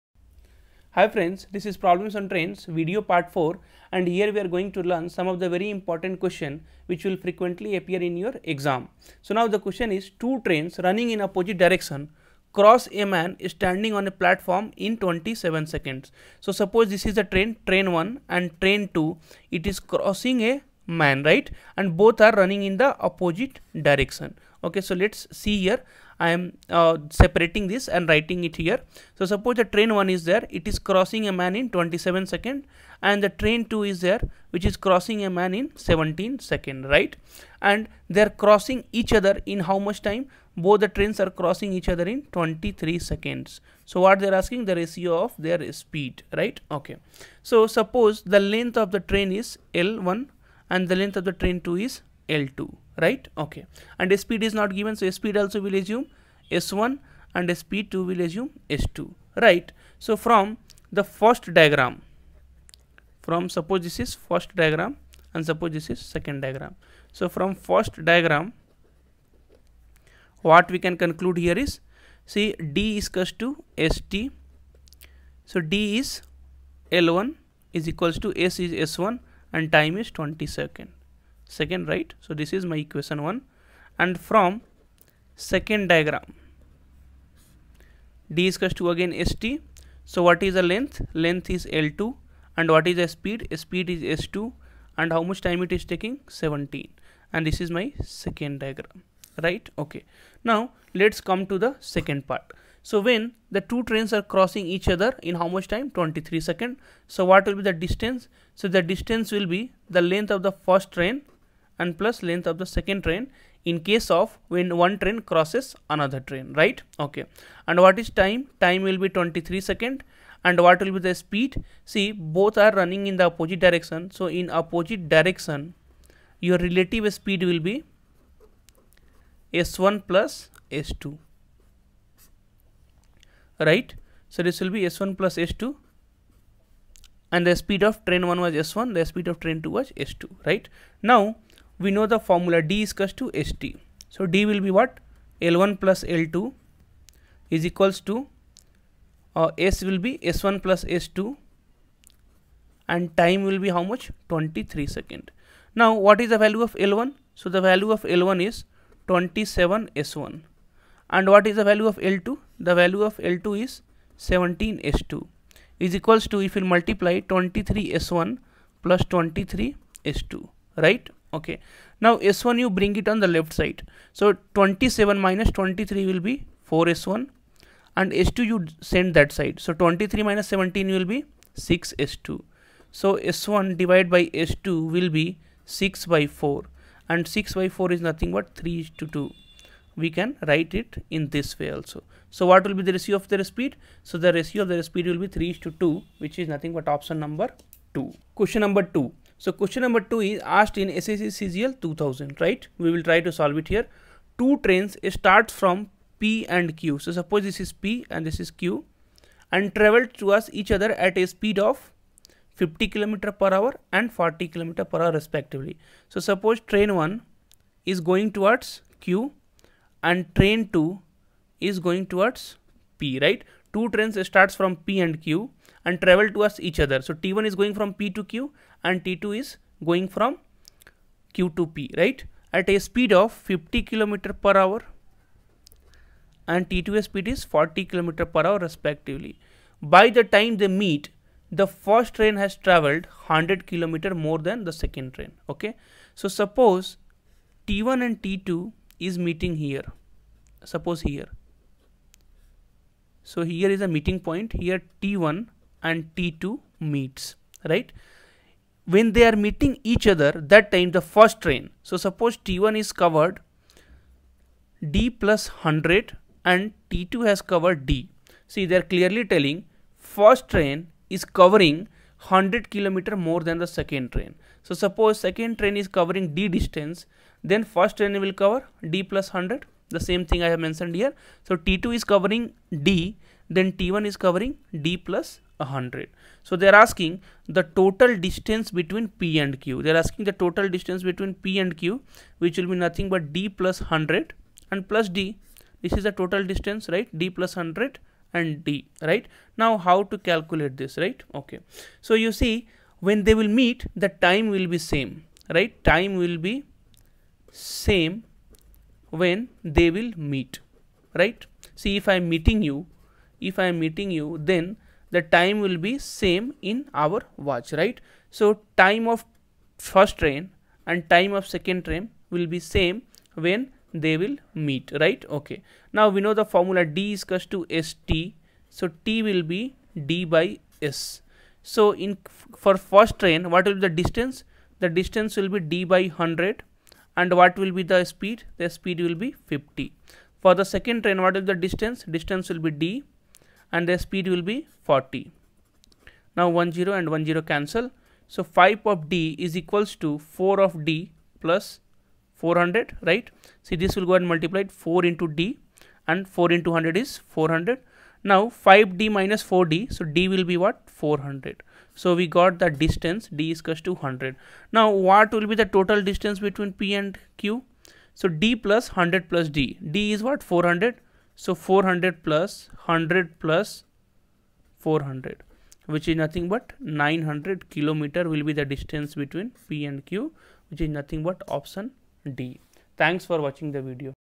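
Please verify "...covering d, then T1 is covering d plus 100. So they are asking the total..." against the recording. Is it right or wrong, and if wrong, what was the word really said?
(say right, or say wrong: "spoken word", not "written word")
right.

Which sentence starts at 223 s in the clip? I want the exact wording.
Two trains starts from P and Q and travel towards each other.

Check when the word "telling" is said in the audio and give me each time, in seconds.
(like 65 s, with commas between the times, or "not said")
269 s.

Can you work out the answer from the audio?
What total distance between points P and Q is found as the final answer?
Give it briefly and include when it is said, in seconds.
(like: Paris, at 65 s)
900 km, at 377 s.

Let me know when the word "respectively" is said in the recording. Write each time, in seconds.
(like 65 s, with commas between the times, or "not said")
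215 s, 238 s.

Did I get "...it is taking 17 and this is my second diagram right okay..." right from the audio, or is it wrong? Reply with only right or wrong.
right.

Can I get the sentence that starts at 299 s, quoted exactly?
Now how to calculate this, right?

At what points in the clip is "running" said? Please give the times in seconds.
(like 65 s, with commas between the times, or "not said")
10 s, 22 s, 122 s.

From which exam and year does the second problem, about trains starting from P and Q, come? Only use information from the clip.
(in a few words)
SSC CGL 2000.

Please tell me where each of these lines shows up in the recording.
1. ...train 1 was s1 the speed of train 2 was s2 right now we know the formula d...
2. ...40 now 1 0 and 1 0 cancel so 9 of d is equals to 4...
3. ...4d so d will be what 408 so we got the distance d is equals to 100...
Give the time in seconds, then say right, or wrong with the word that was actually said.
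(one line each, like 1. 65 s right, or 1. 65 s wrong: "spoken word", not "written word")
1. 138 s right
2. 344 s wrong: "5", not "9"
3. 359 s wrong: "400", not "408".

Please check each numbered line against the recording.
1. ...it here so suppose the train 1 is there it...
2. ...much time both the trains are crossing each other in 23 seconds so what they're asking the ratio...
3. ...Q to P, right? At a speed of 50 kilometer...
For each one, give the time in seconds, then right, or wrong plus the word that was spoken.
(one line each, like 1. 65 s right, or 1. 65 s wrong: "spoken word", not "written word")
1. 28 s right
2. 39 s right
3. 231 s right.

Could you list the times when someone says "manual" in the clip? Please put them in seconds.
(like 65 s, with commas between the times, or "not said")
not said.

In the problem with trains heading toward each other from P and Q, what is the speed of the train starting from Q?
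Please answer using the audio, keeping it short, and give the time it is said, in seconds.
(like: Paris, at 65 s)
40 km/h, at 237 s.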